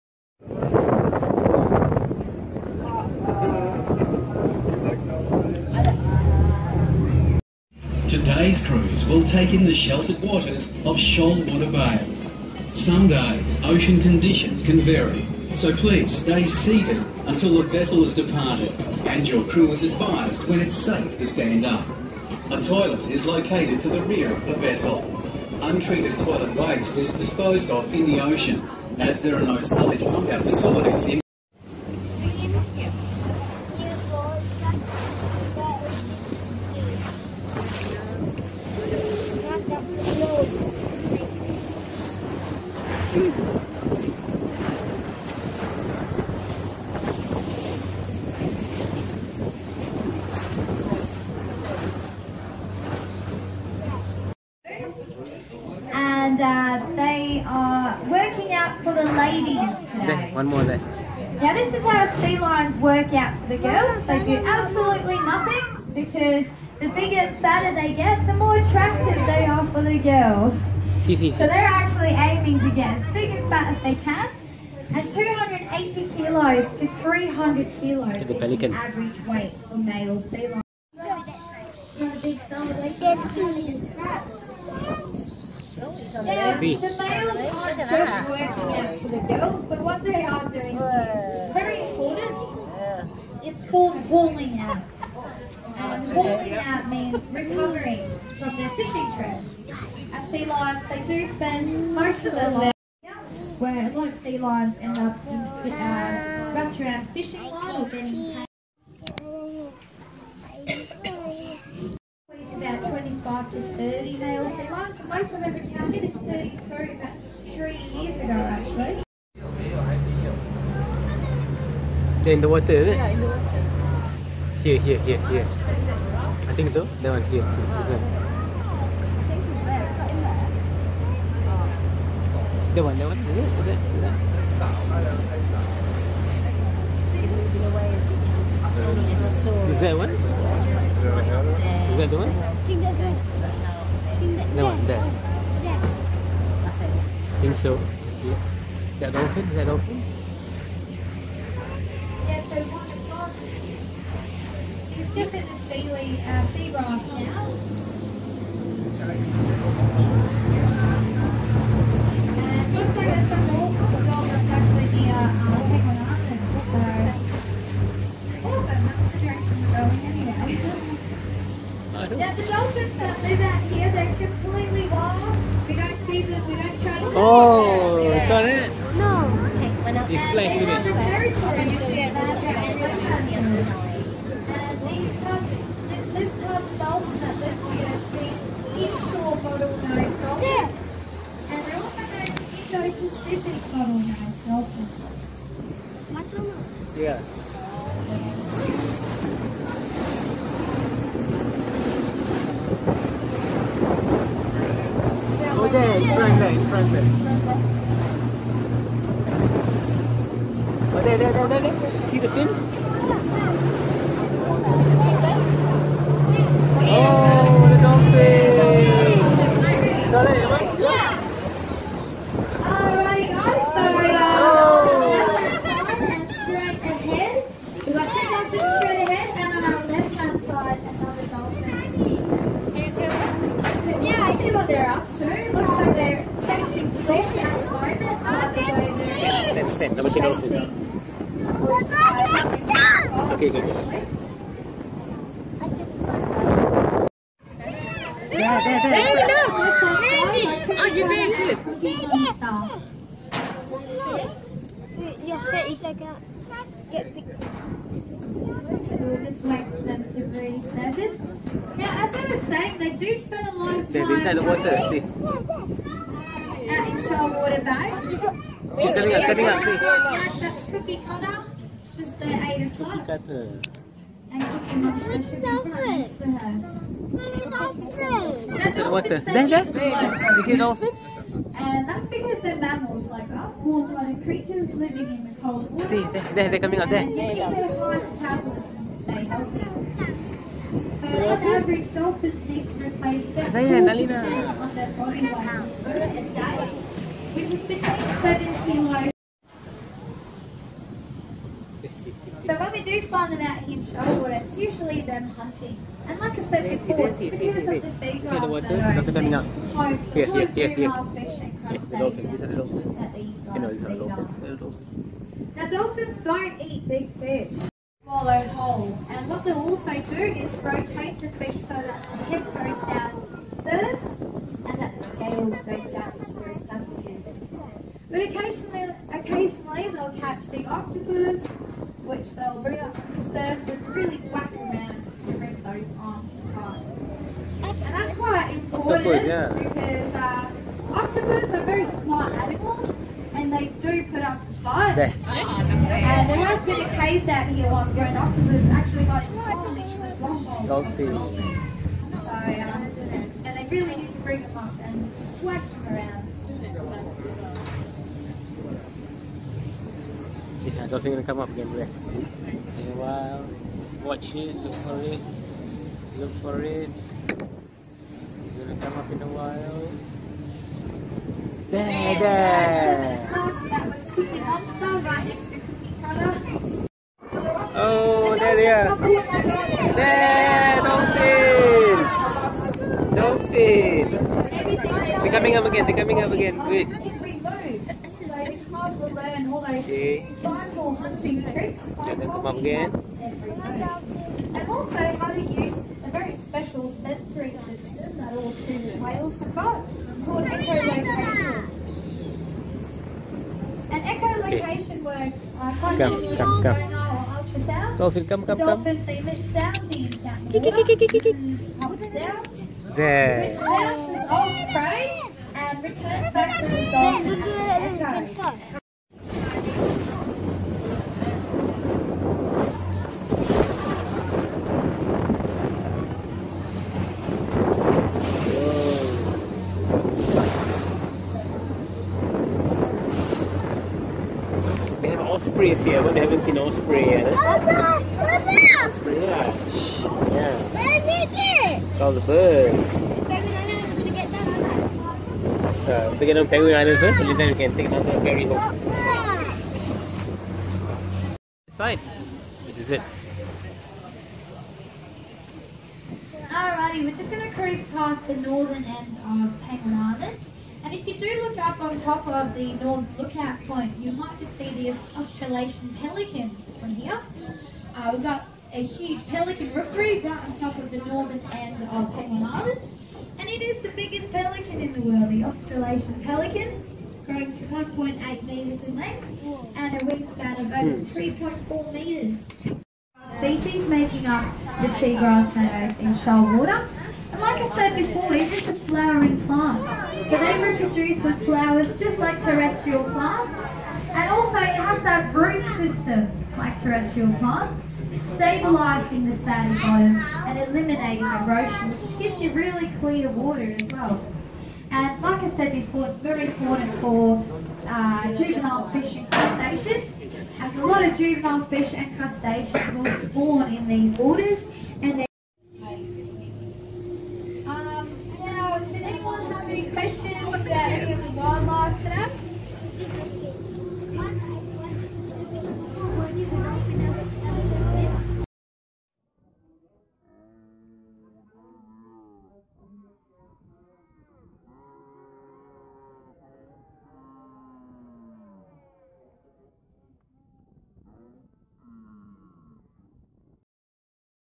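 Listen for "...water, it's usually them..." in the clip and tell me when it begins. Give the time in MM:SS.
05:04.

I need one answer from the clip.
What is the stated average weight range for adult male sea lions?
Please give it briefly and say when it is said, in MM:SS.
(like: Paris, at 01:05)
280 to 300 kilos, at 01:15.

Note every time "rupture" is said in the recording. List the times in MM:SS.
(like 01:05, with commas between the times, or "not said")
01:46.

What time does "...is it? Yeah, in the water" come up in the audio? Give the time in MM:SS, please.
02:02.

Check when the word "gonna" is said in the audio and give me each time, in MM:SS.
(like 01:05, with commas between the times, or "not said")
06:08, 07:37.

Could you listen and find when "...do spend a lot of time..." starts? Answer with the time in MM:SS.
04:22.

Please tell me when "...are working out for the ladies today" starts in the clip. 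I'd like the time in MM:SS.
00:57.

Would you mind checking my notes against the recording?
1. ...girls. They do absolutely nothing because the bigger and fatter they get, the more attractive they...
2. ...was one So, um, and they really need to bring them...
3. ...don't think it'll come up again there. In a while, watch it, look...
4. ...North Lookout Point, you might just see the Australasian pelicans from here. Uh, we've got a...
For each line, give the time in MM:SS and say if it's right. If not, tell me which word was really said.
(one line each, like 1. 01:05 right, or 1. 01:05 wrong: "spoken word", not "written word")
1. 01:03 right
2. 05:49 right
3. 06:00 right
4. 07:42 right.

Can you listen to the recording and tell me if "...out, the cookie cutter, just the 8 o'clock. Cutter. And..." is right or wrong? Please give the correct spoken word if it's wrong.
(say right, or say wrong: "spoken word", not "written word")
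right.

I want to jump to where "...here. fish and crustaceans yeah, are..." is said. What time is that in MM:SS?
05:10.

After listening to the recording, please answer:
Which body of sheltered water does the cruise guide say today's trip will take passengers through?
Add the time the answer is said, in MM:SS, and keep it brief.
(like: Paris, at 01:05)
Shoalwater Bay, at 00:10.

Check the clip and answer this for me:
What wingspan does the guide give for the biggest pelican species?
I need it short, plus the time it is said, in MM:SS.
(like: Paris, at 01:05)
Over 3.4 metres, at 08:00.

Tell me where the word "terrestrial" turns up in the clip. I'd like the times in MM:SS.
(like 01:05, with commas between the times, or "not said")
08:12, 08:16.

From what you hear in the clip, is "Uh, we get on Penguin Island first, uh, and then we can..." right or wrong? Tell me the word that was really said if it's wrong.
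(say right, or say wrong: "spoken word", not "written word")
right.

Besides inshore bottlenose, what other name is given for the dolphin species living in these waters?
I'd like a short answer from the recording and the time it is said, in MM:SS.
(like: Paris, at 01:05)
Indo-Pacific bottlenose dolphins, at 03:12.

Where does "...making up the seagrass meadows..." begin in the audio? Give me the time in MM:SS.
08:03.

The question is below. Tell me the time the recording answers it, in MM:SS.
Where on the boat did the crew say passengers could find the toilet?
00:23.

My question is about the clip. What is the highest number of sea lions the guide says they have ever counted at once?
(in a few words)
32.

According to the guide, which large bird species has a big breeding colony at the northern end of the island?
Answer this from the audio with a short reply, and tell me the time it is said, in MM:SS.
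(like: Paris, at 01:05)
Australasian pelican, at 07:55.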